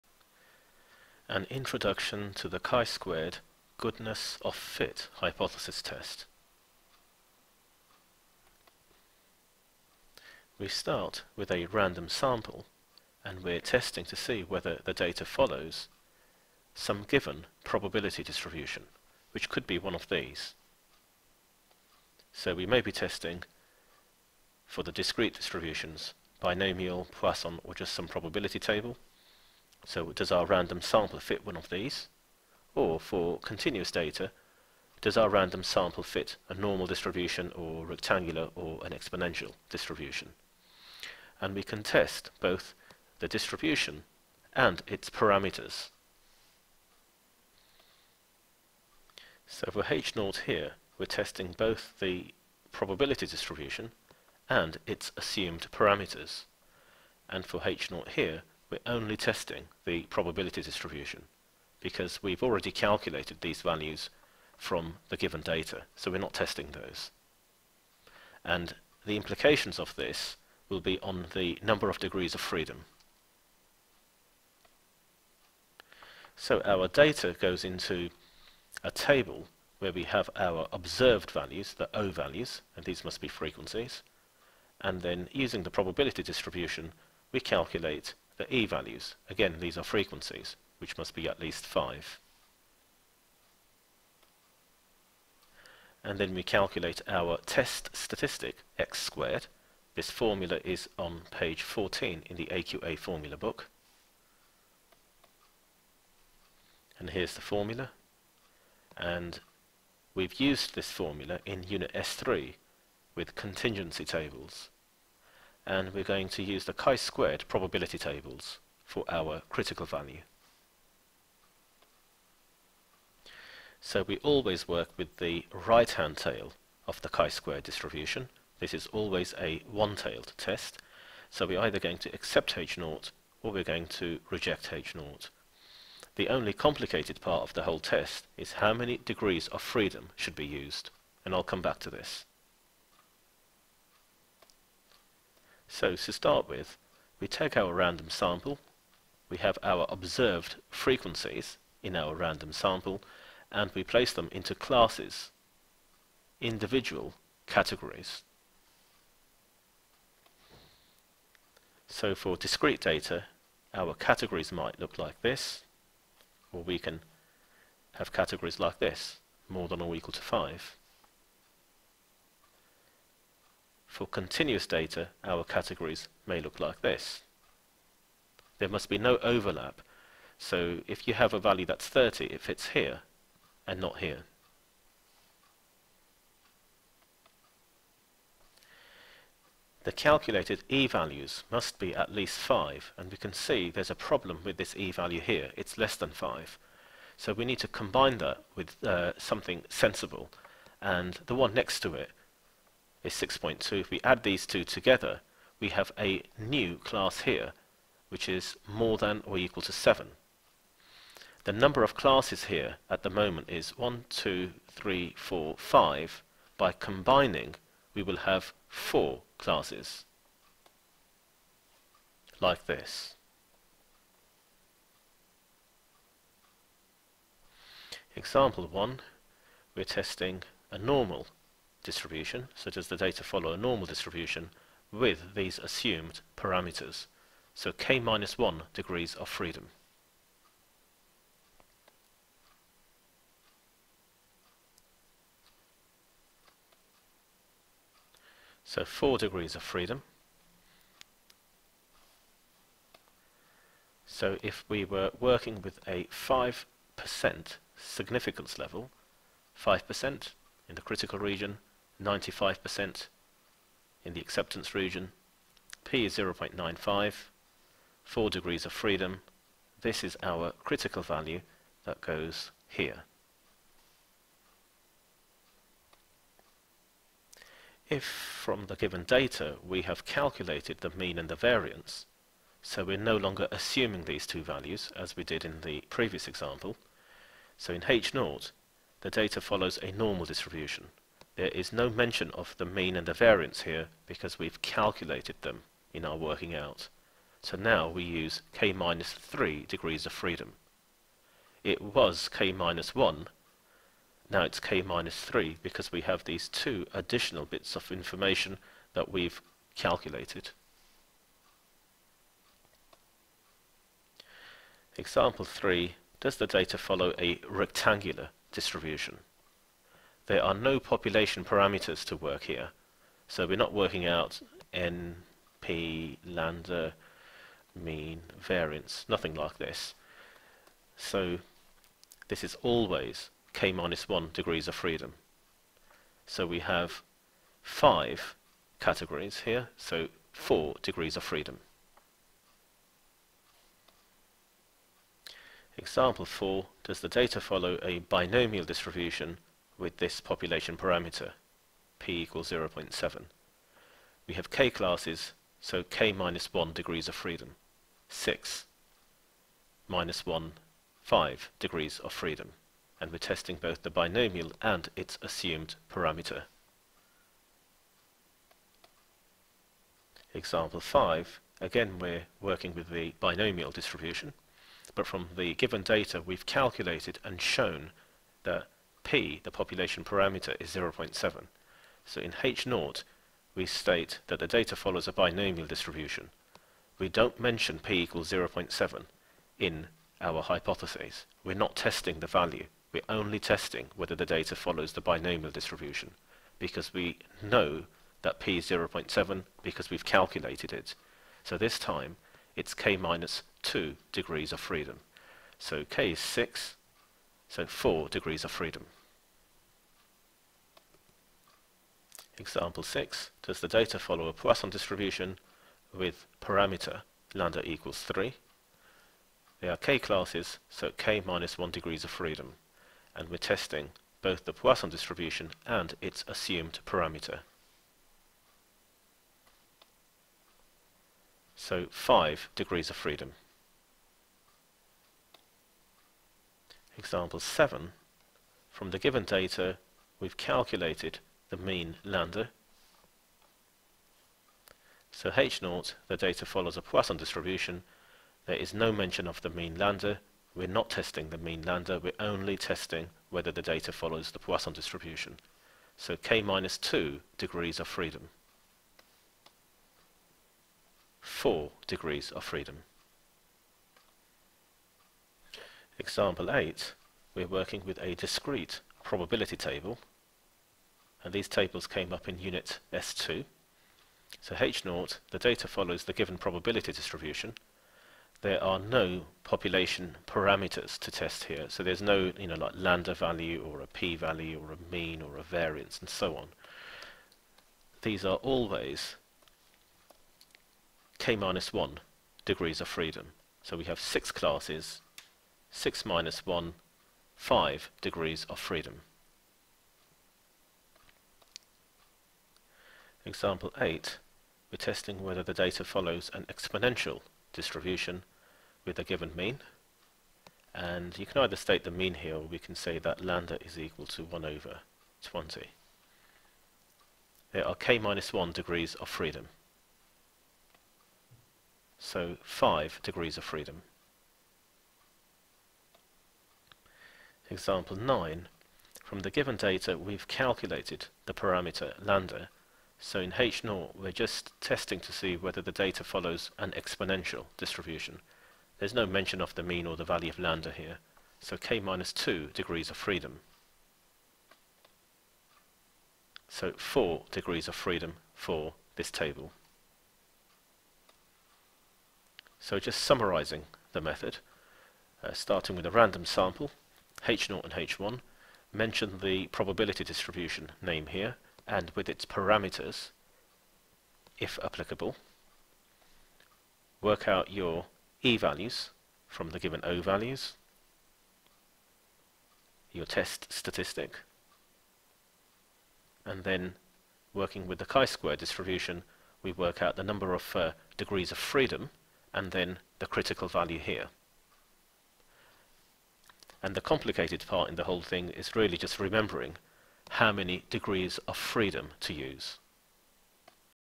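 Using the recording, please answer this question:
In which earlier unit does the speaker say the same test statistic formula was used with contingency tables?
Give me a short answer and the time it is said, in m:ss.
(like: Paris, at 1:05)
S3, at 1:51.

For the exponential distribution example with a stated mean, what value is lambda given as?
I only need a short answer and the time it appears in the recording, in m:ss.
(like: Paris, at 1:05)
1/20, at 8:34.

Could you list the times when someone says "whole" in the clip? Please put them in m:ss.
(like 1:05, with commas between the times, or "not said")
2:17, 9:47.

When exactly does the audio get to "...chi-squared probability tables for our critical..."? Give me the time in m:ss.
1:56.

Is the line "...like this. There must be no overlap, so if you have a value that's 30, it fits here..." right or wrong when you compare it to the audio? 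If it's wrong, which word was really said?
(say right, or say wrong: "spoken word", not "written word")
right.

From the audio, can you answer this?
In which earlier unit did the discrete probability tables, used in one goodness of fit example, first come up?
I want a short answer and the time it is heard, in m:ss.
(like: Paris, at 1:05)
S2, at 7:52.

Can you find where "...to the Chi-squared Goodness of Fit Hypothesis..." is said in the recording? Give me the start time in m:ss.
0:02.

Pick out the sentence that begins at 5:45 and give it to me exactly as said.
Example 4, does the data follow a binomial distribution with this population parameter, p equals 0.7.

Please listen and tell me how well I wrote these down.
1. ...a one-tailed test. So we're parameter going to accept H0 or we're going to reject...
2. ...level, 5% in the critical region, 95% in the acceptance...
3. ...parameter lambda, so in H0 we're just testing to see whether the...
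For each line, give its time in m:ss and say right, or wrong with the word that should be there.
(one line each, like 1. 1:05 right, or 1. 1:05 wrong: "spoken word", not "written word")
1. 2:09 wrong: "either", not "parameter"
2. 4:18 right
3. 8:51 right.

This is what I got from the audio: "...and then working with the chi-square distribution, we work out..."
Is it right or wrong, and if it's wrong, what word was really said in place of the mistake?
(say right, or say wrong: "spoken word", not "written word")
right.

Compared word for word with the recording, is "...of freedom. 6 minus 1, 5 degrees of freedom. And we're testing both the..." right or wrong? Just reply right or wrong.
right.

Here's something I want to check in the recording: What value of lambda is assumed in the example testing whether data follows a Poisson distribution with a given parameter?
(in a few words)
3.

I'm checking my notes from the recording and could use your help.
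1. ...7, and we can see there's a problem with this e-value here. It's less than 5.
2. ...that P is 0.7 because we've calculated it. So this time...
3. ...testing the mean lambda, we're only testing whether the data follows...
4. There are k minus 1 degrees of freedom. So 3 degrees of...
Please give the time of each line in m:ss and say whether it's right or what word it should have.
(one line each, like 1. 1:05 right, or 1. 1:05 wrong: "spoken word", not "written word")
1. 3:12 wrong: "5", not "7"
2. 6:38 right
3. 7:30 right
4. 8:37 wrong: "5", not "3".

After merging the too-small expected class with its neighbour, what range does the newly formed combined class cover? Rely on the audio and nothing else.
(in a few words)
more than or equal to 7.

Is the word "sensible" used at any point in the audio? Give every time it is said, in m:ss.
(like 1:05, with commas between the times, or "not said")
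3:19.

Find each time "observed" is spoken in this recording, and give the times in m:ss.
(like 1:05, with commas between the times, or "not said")
1:20, 2:29.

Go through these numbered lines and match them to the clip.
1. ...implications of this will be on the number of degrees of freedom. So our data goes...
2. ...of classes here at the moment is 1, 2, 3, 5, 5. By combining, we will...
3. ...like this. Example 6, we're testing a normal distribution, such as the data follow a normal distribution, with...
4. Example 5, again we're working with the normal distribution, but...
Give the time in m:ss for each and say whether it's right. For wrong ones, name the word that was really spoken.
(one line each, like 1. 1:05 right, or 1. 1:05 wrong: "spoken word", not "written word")
1. 1:09 right
2. 3:31 wrong: "4", not "5"
3. 3:42 wrong: "1", not "6"
4. 6:10 wrong: "binomial", not "normal".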